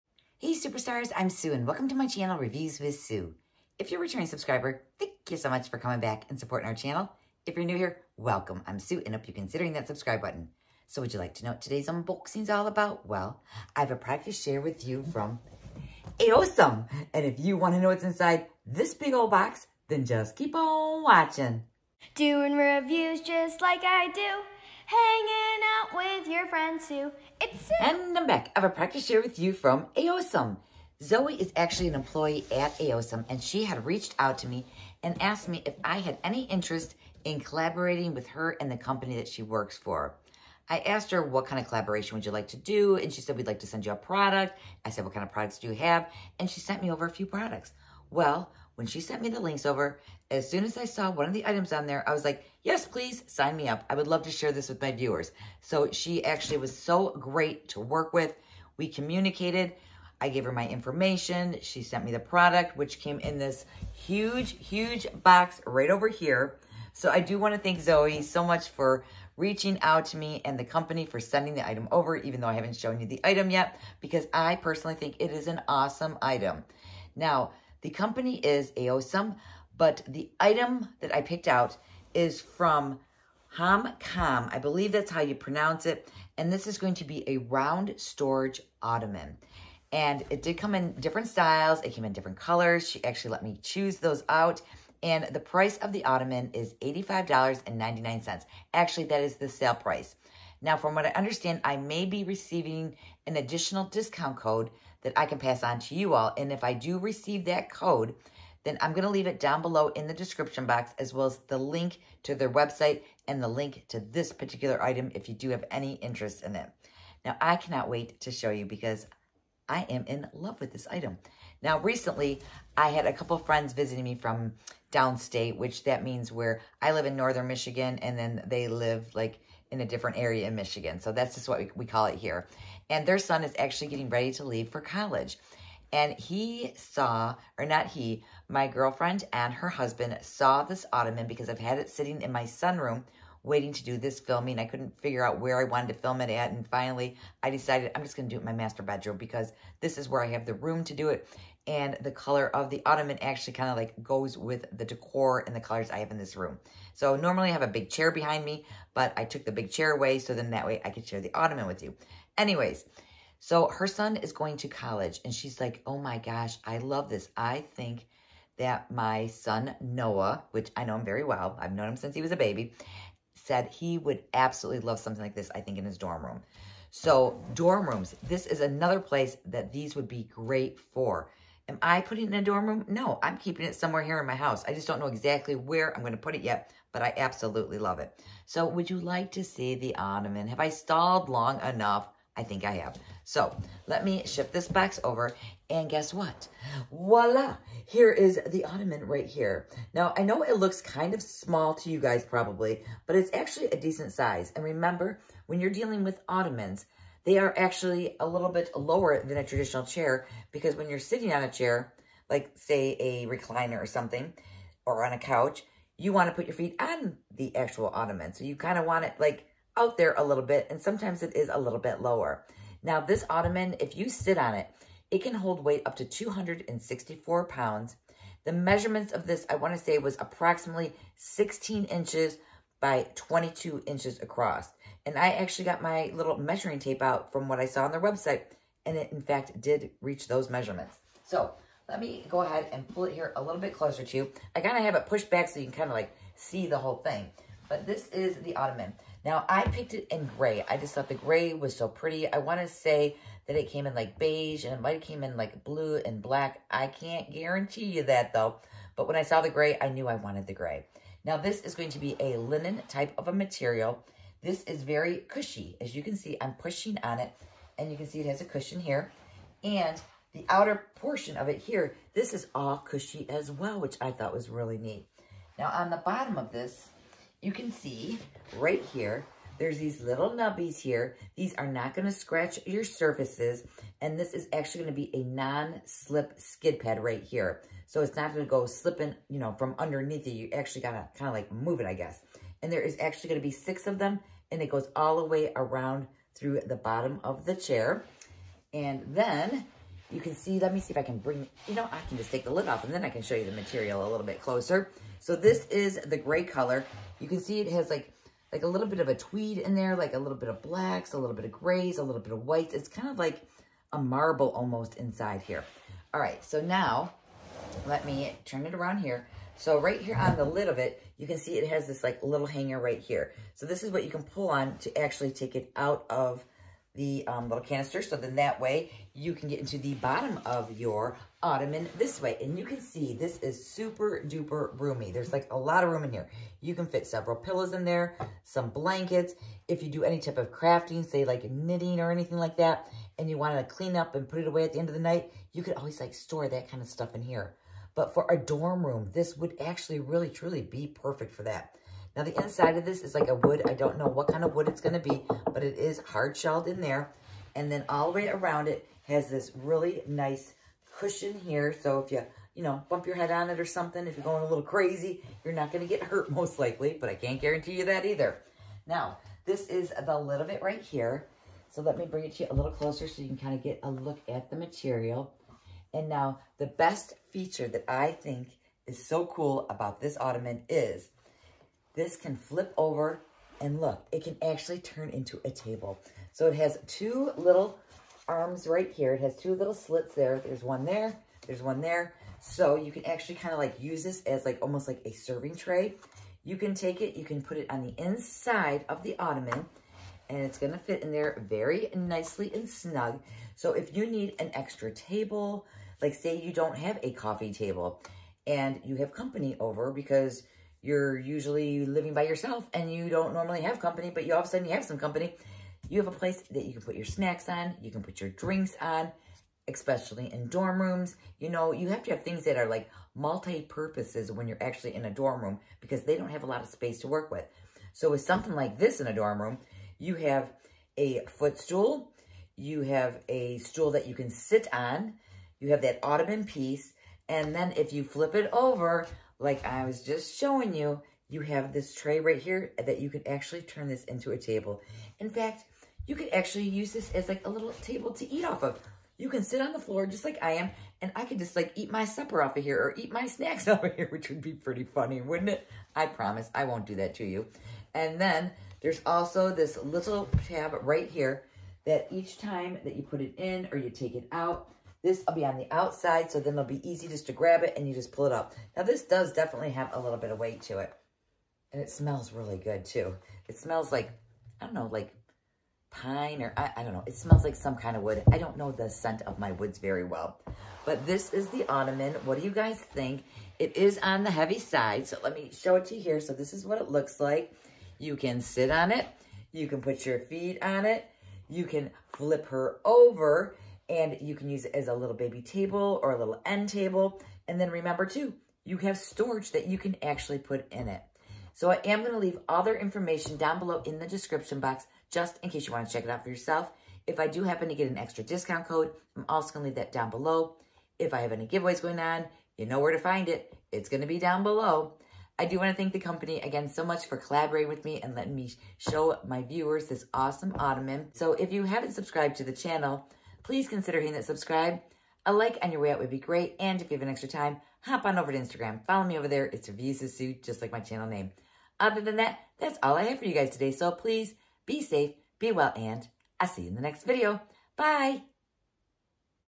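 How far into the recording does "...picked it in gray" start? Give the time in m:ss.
4:09.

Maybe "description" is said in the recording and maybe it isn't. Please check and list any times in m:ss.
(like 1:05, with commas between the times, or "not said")
1:50, 8:24.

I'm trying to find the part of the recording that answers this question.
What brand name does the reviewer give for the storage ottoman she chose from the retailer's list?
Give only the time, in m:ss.
1:23.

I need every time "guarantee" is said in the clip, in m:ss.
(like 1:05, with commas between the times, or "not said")
4:17, 6:07.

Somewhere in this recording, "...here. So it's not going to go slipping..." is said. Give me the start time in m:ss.
4:47.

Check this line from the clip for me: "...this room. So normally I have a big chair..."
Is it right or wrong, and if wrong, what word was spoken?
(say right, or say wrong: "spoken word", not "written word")
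right.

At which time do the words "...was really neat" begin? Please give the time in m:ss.
4:34.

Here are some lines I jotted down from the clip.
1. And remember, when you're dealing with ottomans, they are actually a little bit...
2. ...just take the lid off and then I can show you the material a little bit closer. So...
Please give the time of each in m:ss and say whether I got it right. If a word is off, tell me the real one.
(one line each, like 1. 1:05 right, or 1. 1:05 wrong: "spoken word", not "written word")
1. 3:24 right
2. 5:02 right.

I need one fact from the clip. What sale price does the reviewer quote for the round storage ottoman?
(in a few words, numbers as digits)
$85.99.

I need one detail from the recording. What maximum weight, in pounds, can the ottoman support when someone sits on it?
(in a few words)
264 pounds.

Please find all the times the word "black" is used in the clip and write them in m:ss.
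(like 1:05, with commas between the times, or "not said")
4:16, 5:10.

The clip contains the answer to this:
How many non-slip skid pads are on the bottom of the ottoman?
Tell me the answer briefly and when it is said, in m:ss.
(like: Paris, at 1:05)
6, at 4:53.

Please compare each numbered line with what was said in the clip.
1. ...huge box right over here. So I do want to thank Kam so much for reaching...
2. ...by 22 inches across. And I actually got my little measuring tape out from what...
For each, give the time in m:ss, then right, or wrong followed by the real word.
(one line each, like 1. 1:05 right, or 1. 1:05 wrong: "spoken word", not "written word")
1. 1:04 wrong: "Zoe", not "Kam"
2. 3:52 right.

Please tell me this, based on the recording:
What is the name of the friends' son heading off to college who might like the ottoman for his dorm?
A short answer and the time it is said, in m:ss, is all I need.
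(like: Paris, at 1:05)
Noah, at 2:49.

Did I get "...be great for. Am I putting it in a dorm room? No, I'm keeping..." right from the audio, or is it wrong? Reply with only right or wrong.
right.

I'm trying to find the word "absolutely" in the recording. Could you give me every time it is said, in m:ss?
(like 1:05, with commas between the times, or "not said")
2:54, 3:07.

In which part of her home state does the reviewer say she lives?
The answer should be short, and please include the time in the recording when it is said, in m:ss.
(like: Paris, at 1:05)
northern Michigan, at 2:07.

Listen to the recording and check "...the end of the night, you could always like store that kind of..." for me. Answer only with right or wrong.
right.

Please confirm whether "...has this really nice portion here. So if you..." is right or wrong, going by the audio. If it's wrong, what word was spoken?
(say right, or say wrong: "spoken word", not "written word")
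wrong: "cushion", not "portion".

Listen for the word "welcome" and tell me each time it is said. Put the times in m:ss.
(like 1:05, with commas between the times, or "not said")
0:01, 0:08.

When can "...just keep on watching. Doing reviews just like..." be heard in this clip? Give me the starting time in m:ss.
0:20.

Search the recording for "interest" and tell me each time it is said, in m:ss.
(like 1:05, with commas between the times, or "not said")
0:36, 1:55.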